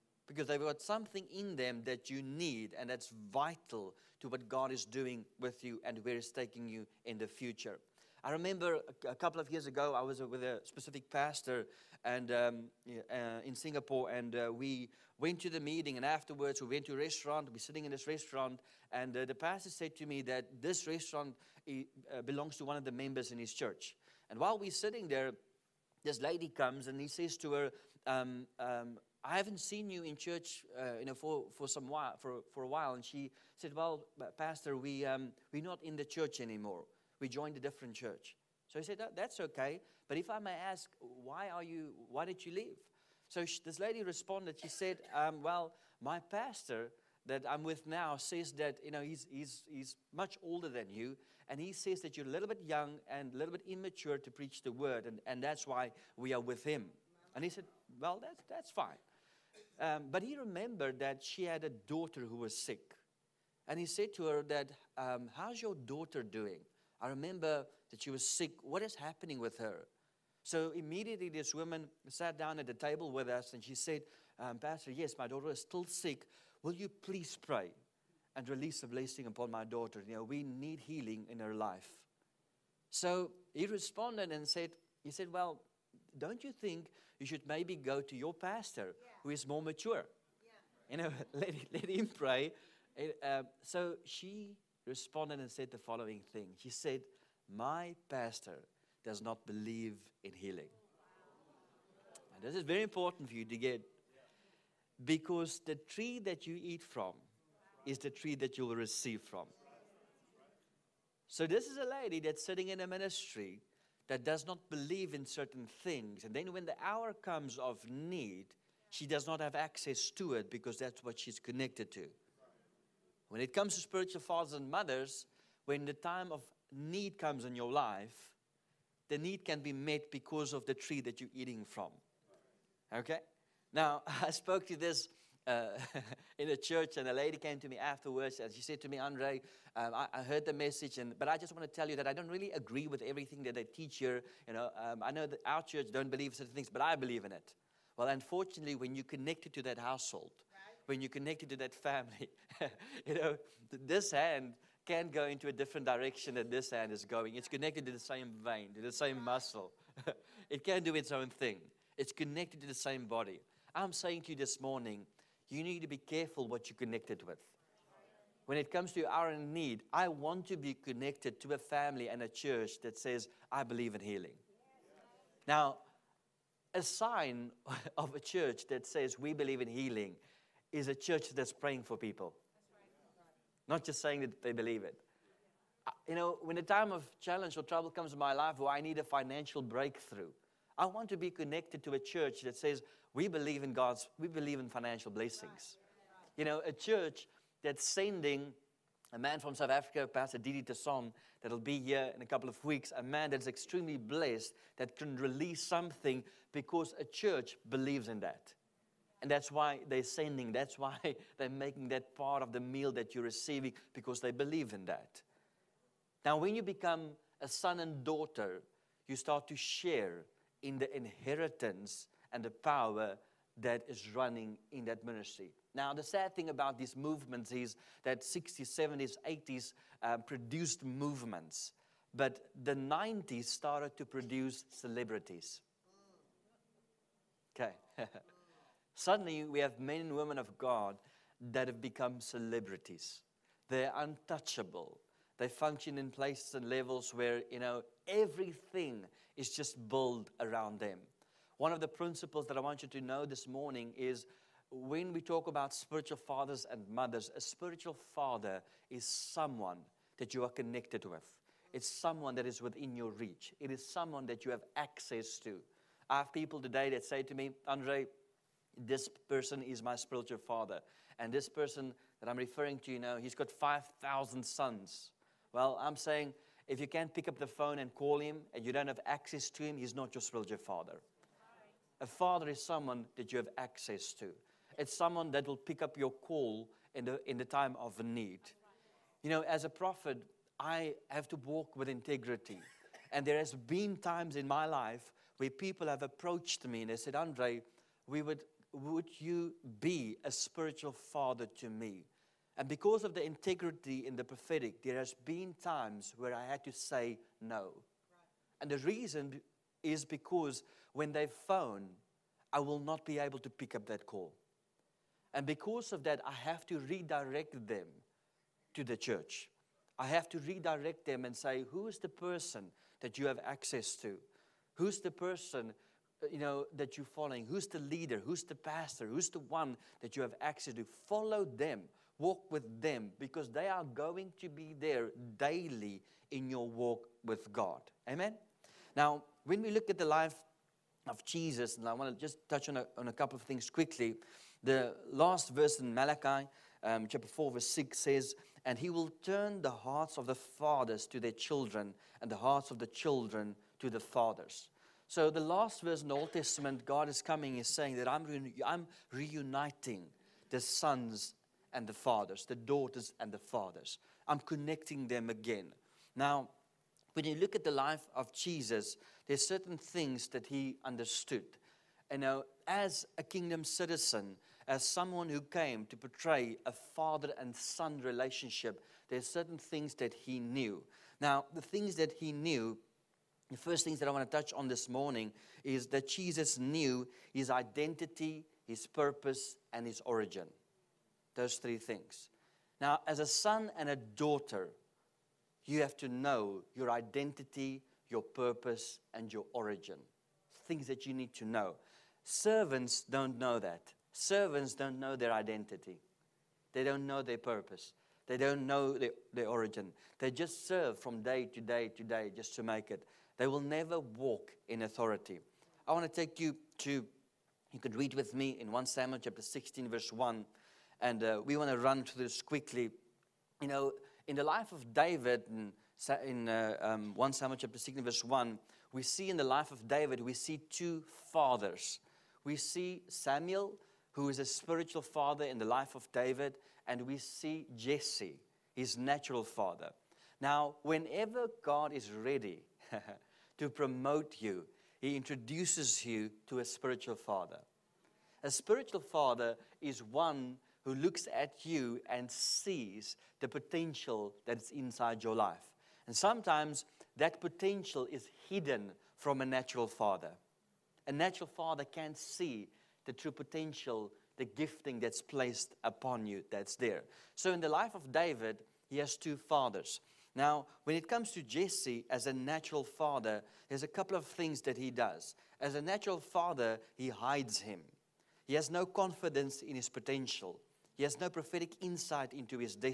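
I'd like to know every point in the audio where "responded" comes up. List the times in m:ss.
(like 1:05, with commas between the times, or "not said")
0:44, 1:23, 1:34.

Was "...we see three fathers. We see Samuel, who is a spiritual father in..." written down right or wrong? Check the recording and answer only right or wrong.
wrong.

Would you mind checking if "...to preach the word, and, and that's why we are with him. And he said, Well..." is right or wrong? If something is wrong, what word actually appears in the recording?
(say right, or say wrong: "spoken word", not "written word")
right.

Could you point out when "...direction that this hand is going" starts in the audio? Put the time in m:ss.
2:35.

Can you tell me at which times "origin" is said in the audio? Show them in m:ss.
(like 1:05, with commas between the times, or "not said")
6:30, 6:39, 6:49.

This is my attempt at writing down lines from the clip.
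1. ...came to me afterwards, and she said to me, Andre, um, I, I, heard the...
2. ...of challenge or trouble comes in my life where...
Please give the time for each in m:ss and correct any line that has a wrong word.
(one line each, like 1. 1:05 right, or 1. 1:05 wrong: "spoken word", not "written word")
1. 2:17 right
2. 3:06 right.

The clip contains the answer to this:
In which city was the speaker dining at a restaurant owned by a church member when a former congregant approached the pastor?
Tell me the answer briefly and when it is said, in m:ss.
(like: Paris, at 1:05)
Singapore, at 0:13.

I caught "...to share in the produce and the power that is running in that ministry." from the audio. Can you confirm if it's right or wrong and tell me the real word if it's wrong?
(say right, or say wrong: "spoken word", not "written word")
wrong: "inheritance", not "produce".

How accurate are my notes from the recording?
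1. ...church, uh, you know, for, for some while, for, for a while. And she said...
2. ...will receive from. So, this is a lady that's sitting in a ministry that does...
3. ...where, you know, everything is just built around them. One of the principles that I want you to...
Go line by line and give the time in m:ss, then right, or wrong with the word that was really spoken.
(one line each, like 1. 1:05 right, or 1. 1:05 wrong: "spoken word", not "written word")
1. 0:30 right
2. 1:48 right
3. 4:07 right.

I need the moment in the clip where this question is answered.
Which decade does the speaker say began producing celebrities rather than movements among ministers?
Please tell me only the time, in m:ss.
3:52.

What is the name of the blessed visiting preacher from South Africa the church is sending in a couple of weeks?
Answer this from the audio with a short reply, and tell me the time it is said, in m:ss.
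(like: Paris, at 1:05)
Didi Tasson, at 3:20.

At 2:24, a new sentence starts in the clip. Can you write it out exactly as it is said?
You know, um, I know that our church don't believe certain things, but I believe in it.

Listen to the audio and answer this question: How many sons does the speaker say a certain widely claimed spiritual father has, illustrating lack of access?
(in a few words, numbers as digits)
5,000.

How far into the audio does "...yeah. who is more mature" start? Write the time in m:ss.
1:29.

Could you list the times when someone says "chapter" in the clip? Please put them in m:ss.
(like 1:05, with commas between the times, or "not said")
5:47, 6:59, 7:07.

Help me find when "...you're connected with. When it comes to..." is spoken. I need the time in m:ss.
2:46.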